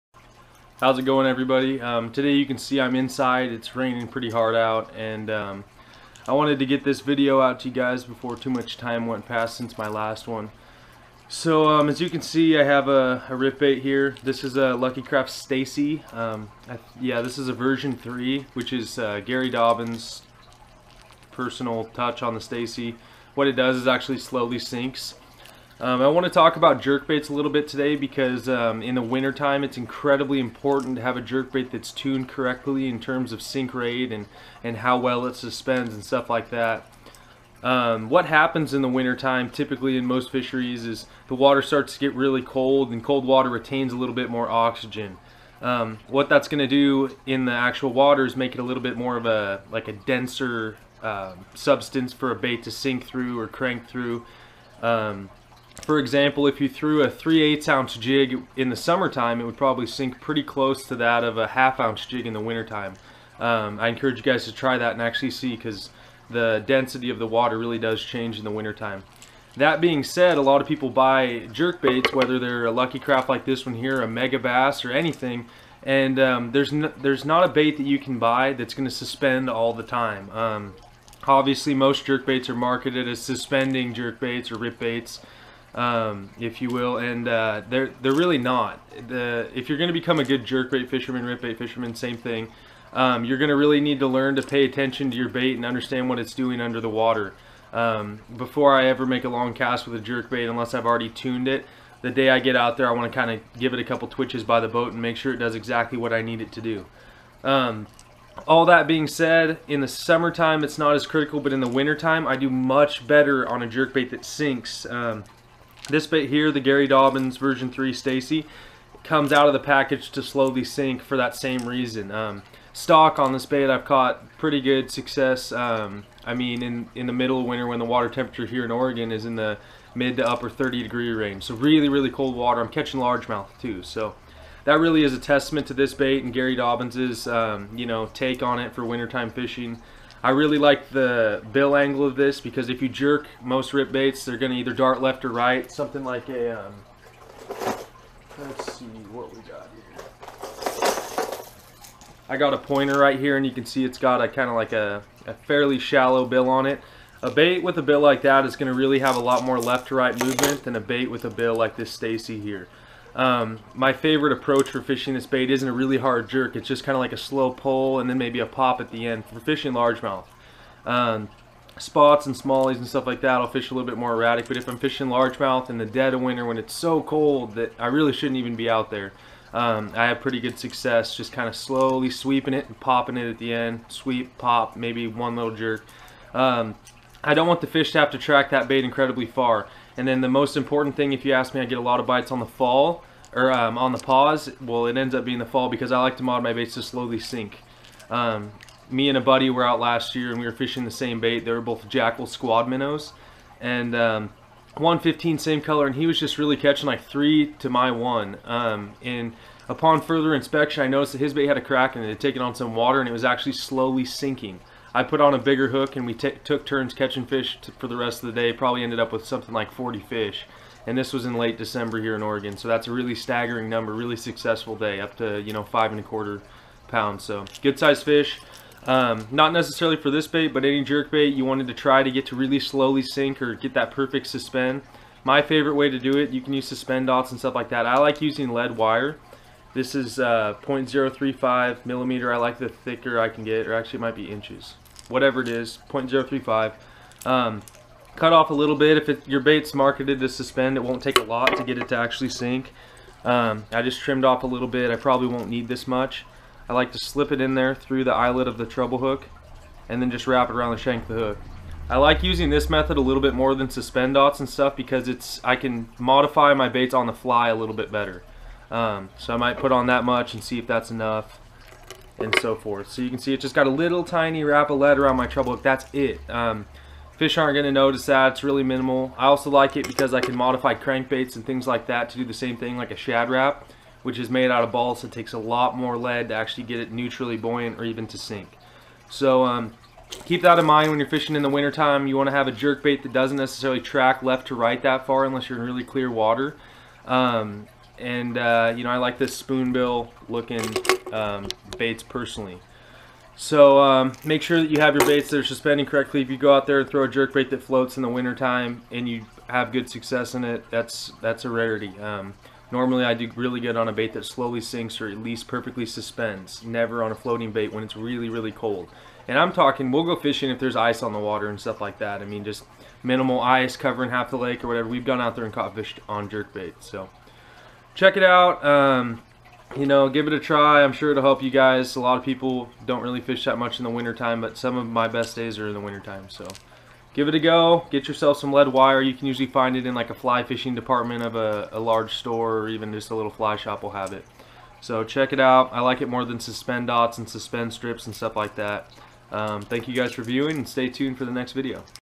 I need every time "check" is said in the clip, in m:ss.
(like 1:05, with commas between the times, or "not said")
5:27, 5:45.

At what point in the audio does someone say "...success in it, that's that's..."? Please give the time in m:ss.
5:09.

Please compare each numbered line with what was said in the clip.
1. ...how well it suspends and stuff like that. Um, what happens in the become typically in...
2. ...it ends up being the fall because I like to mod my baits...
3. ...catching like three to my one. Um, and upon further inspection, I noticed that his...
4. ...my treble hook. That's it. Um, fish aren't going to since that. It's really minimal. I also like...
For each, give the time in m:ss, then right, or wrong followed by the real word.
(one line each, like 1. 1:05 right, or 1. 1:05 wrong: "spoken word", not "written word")
1. 0:34 wrong: "wintertime", not "become"
2. 3:14 right
3. 3:26 right
4. 4:35 wrong: "notice", not "since".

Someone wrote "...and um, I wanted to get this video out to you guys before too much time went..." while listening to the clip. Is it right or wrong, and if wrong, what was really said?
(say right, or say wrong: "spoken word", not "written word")
right.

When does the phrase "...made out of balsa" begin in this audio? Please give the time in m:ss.
4:44.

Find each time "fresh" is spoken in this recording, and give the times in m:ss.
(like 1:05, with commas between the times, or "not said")
not said.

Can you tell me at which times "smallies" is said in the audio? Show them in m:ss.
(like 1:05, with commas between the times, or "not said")
2:52.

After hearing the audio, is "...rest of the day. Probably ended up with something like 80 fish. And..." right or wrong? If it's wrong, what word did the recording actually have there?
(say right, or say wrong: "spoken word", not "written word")
wrong: "40", not "80".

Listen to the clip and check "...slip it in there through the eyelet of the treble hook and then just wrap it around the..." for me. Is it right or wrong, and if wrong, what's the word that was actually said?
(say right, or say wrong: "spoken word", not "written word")
right.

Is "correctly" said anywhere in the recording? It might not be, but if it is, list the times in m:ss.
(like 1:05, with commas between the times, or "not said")
0:32, 5:05.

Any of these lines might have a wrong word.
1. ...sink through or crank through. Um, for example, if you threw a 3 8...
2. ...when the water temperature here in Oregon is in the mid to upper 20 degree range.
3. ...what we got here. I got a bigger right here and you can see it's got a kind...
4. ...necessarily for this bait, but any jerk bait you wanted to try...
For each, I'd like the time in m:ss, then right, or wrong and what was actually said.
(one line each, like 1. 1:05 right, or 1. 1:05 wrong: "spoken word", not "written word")
1. 0:52 right
2. 2:07 wrong: "30", not "20"
3. 2:29 wrong: "pointer", not "bigger"
4. 3:49 right.